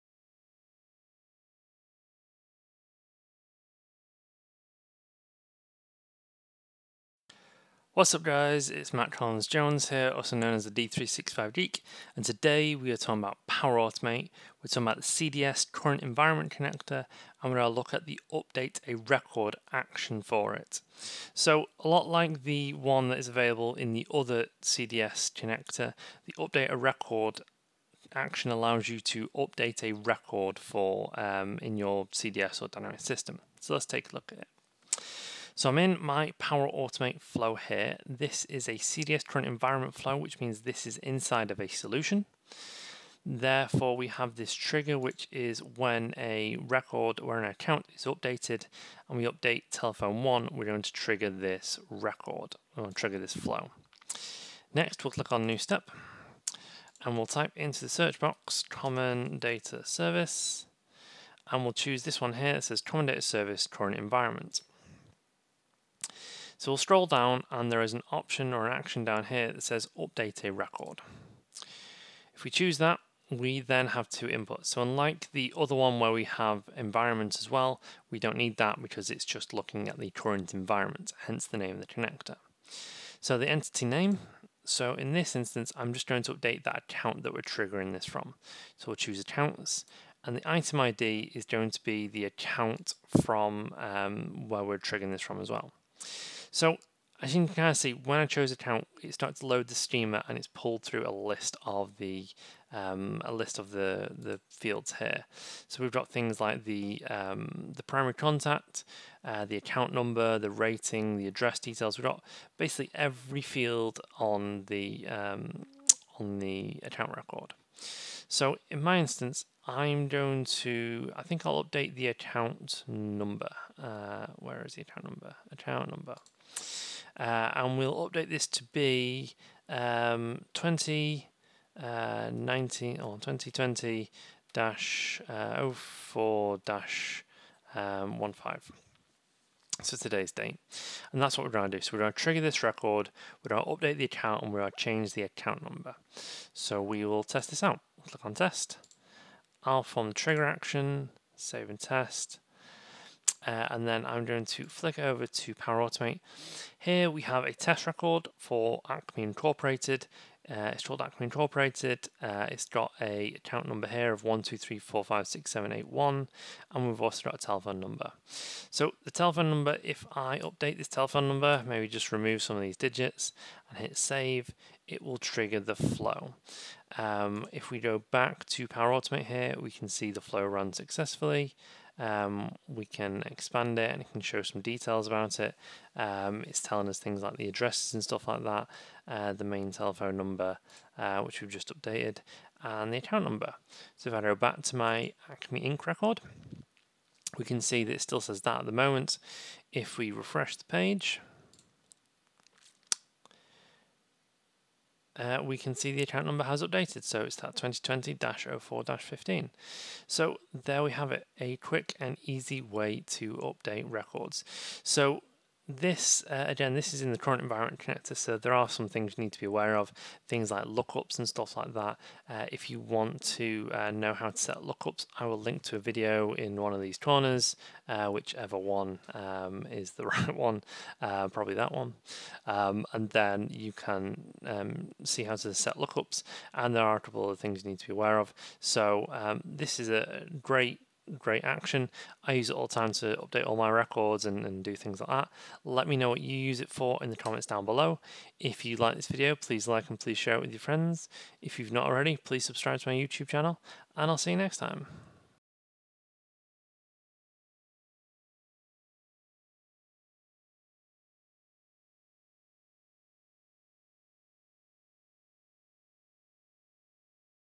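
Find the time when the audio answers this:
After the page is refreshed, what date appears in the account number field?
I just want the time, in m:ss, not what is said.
3:27.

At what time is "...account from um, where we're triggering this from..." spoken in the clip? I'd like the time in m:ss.
1:32.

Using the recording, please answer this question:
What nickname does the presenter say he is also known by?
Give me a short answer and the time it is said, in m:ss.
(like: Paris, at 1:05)
The D365 Geek, at 0:10.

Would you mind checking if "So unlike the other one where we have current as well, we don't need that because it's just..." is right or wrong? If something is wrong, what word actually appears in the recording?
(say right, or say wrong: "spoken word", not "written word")
wrong: "environment", not "current".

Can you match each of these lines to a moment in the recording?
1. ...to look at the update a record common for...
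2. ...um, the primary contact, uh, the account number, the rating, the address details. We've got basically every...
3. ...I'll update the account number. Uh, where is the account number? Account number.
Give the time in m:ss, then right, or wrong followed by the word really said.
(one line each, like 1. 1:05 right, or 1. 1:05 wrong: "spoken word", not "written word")
1. 0:17 wrong: "action", not "common"
2. 1:47 right
3. 2:01 right.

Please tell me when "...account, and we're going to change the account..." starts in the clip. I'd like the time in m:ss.
2:24.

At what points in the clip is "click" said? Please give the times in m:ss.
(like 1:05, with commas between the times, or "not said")
0:55, 2:28.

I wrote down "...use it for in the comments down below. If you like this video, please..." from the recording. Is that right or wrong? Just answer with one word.
right.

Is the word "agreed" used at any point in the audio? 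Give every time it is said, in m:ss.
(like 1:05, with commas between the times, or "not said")
not said.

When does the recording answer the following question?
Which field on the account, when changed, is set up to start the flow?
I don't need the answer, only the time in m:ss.
0:49.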